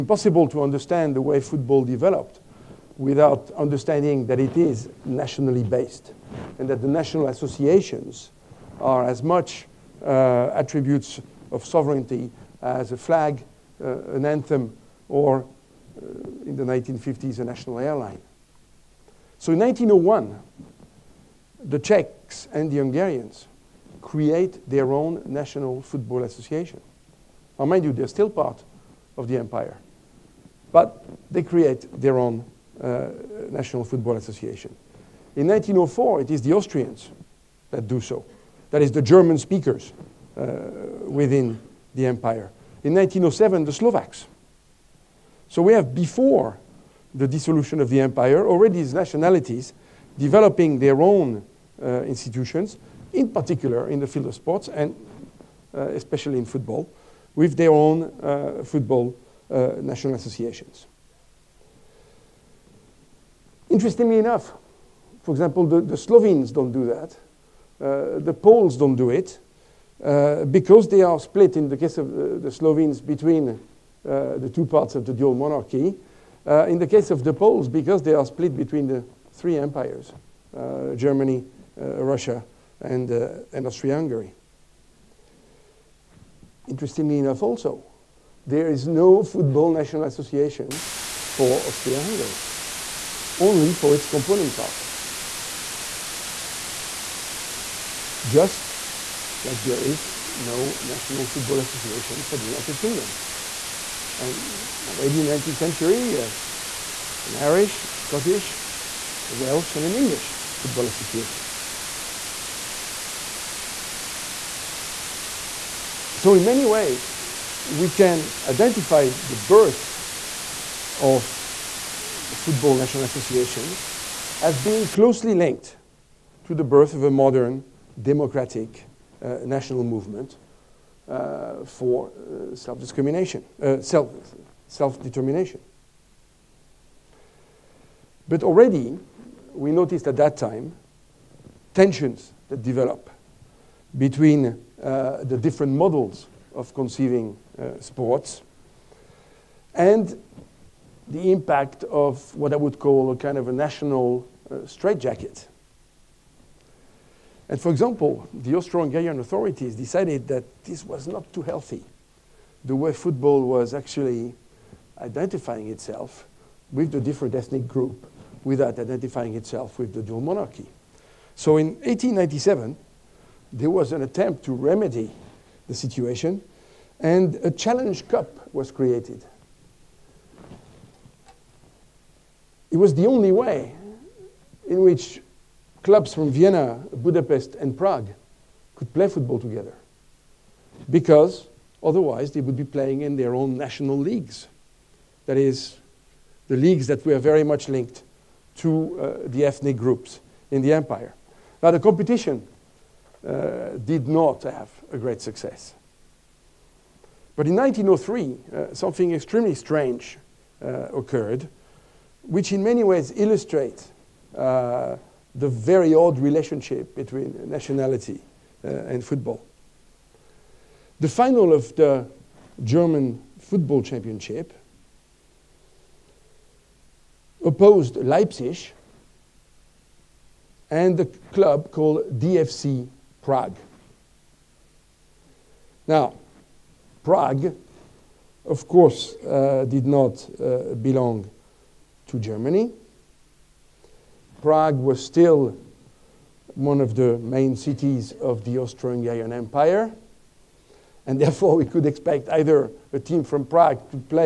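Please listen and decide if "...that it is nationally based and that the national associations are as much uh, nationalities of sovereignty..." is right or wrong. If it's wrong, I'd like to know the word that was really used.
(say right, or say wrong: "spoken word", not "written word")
wrong: "attributes", not "nationalities".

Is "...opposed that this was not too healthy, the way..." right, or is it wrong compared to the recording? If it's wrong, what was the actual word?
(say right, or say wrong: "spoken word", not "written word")
wrong: "decided", not "opposed".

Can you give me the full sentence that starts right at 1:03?
Interestingly enough, for example, the, the Slovenes don't do that.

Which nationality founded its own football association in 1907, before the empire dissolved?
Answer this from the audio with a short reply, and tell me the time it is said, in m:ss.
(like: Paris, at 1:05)
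Slovaks, at 0:43.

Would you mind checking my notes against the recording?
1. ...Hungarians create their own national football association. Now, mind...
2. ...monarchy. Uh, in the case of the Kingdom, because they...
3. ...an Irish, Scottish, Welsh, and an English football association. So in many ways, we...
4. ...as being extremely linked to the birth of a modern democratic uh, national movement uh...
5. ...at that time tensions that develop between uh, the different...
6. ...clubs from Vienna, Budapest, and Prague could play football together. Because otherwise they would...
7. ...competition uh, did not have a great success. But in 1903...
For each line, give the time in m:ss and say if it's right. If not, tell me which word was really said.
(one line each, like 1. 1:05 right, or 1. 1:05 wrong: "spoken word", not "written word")
1. 0:22 right
2. 1:15 wrong: "Poles", not "Kingdom"
3. 1:47 right
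4. 2:04 wrong: "closely", not "extremely"
5. 2:20 right
6. 3:05 right
7. 3:21 right.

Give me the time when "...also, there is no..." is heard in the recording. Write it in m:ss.
1:27.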